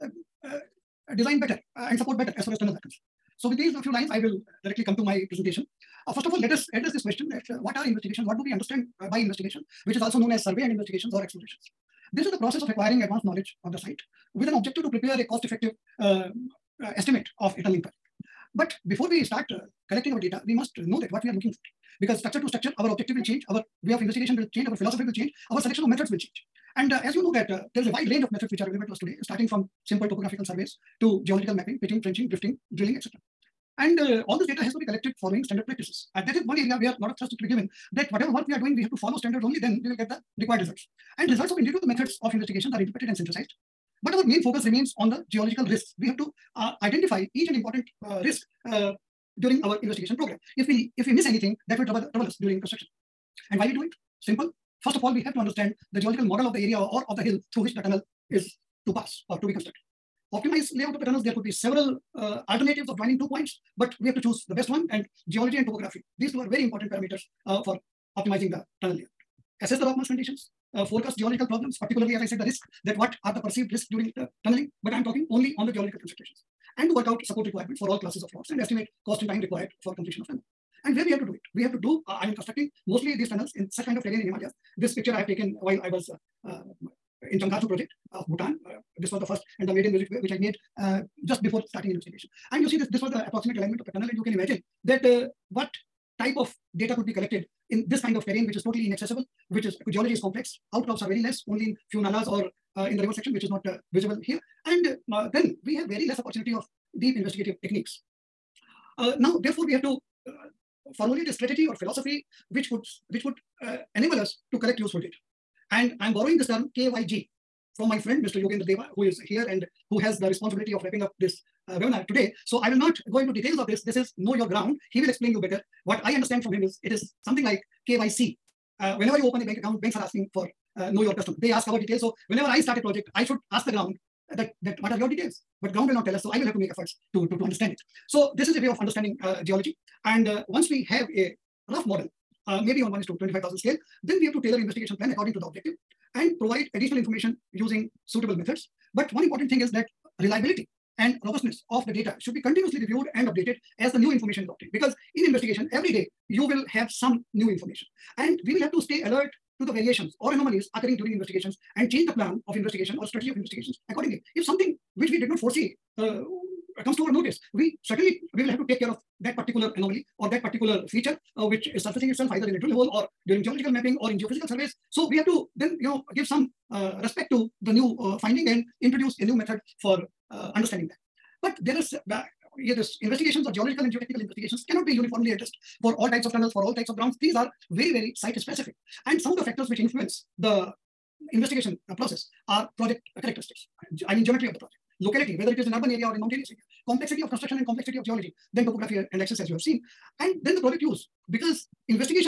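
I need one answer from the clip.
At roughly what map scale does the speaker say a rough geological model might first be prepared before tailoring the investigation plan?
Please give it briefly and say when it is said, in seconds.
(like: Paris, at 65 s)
1:25,000, at 142 s.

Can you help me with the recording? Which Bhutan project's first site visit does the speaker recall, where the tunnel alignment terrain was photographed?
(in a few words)
Changarju project.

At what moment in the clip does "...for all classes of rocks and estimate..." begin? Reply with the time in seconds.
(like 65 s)
77 s.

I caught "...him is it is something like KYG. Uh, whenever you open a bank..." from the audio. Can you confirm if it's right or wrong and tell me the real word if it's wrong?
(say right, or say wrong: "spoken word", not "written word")
wrong: "KYC", not "KYG".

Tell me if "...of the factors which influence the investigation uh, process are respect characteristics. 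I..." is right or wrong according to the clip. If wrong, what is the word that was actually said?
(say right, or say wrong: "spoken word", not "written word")
wrong: "project", not "respect".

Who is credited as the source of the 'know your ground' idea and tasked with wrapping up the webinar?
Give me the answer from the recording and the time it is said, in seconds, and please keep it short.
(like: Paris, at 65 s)
Yogendra Deva, at 118 s.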